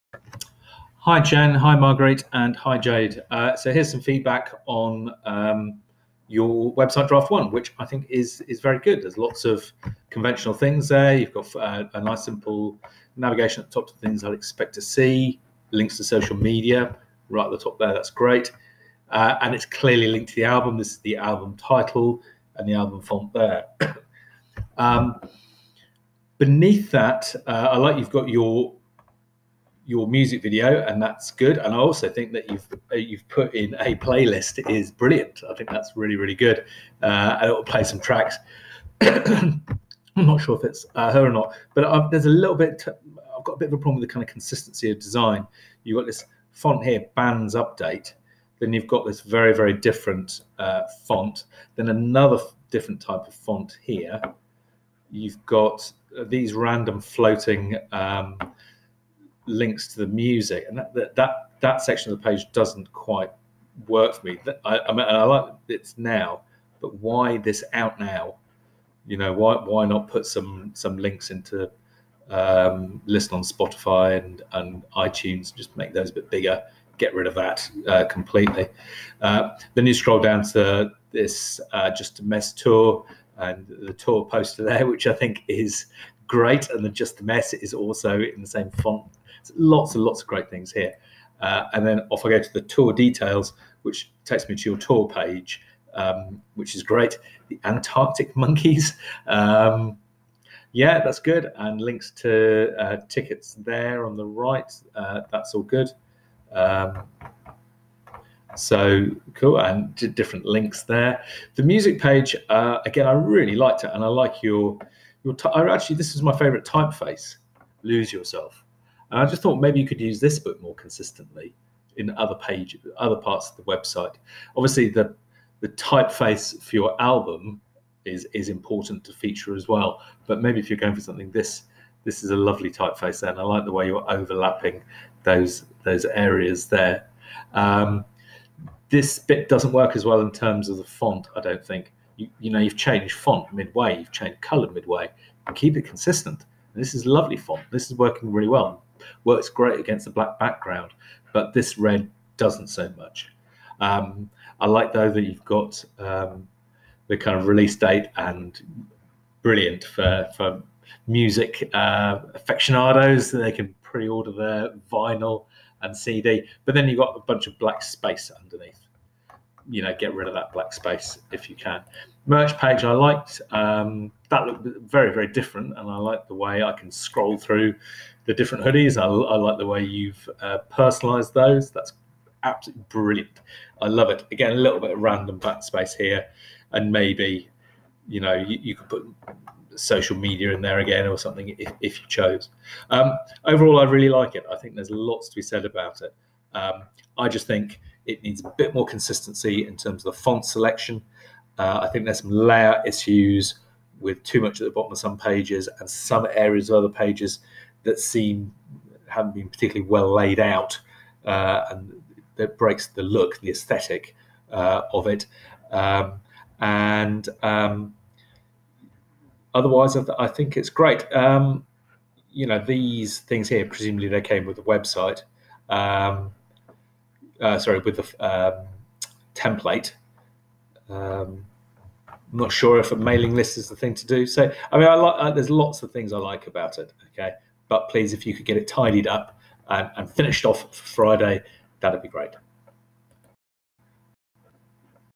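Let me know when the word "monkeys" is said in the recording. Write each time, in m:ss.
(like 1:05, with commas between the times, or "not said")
1:38.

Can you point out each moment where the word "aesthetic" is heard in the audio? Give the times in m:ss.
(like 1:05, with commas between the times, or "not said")
3:33.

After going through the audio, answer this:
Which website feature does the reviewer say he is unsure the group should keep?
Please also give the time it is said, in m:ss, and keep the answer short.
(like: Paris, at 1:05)
Mailing list, at 3:52.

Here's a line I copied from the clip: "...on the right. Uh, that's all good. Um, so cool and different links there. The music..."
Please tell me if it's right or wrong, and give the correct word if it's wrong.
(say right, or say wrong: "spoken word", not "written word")
right.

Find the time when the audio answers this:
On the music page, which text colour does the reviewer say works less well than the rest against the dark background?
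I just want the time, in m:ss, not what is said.
2:31.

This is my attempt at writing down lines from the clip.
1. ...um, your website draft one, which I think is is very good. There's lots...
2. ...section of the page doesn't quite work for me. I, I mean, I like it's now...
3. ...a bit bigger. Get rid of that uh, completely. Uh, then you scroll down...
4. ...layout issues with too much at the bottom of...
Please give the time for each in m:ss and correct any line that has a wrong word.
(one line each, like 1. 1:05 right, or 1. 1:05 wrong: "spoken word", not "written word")
1. 0:05 right
2. 1:01 right
3. 1:16 right
4. 3:22 right.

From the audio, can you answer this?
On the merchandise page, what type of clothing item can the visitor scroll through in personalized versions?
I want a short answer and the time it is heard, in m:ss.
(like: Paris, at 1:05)
Hoodies, at 2:58.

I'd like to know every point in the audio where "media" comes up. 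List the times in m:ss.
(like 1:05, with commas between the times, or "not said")
0:16, 3:10.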